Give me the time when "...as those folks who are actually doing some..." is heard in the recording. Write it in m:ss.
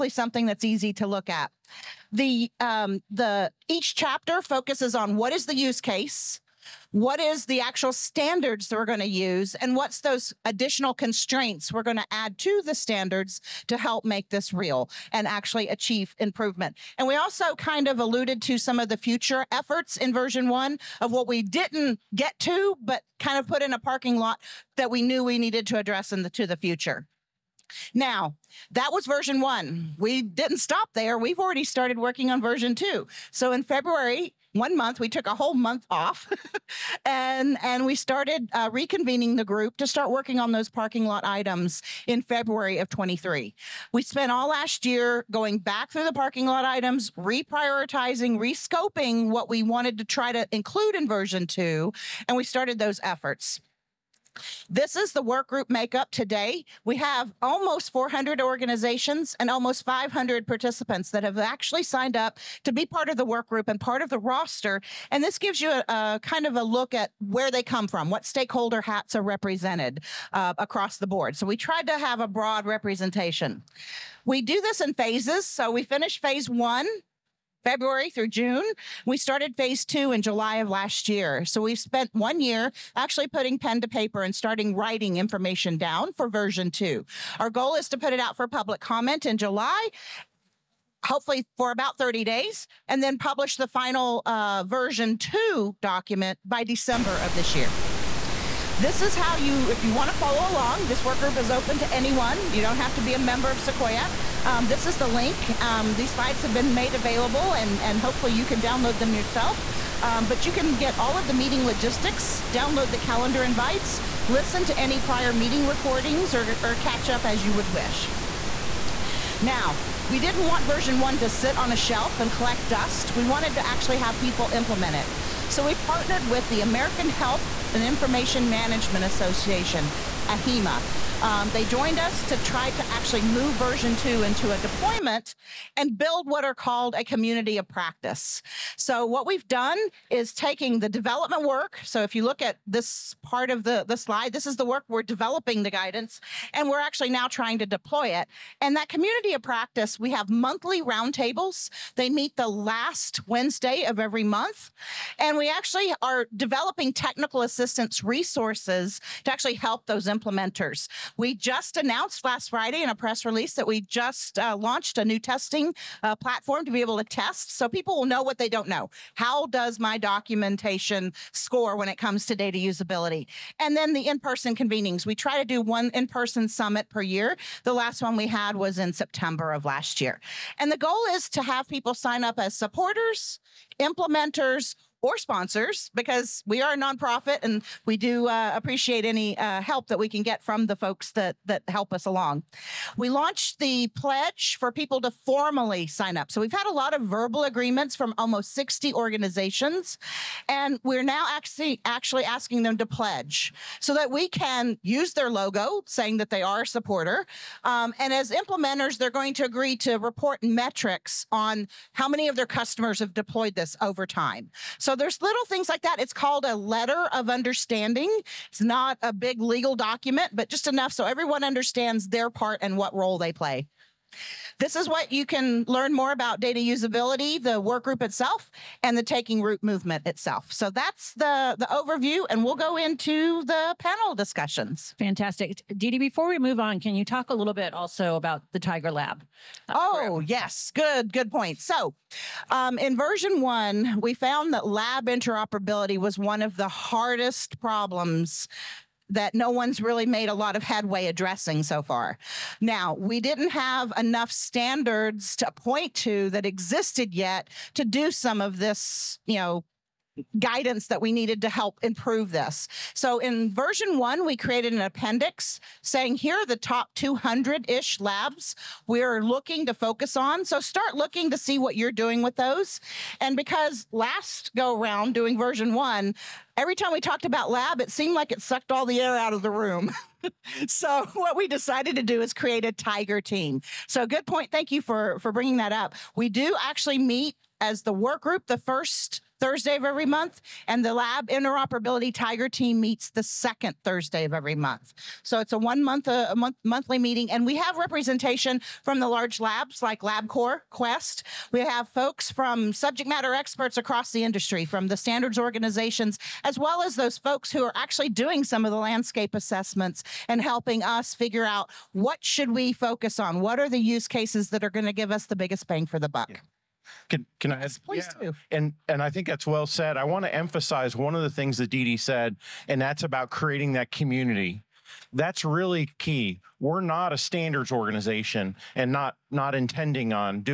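5:06.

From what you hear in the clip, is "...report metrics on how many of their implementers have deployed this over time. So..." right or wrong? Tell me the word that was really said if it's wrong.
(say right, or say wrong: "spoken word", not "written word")
wrong: "customers", not "implementers".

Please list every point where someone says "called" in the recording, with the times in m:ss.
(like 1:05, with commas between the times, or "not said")
2:16, 3:36.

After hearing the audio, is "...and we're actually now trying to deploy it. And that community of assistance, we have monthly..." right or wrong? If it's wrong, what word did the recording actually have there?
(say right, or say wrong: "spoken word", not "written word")
wrong: "practice", not "assistance".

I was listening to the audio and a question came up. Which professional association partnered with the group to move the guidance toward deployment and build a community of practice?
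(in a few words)
AHIMA.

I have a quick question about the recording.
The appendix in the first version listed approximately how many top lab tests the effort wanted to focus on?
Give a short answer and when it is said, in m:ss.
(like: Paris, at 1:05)
200, at 4:26.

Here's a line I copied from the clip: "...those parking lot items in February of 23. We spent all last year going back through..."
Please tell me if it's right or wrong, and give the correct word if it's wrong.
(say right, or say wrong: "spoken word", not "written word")
right.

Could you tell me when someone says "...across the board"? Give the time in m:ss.
1:10.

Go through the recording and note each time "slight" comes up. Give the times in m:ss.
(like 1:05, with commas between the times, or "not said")
not said.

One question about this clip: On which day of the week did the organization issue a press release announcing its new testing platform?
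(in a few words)
Friday.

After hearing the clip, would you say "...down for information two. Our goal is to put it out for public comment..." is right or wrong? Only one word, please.
wrong.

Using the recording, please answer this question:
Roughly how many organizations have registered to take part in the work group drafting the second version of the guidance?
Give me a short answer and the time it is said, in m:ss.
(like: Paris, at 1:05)
400, at 0:57.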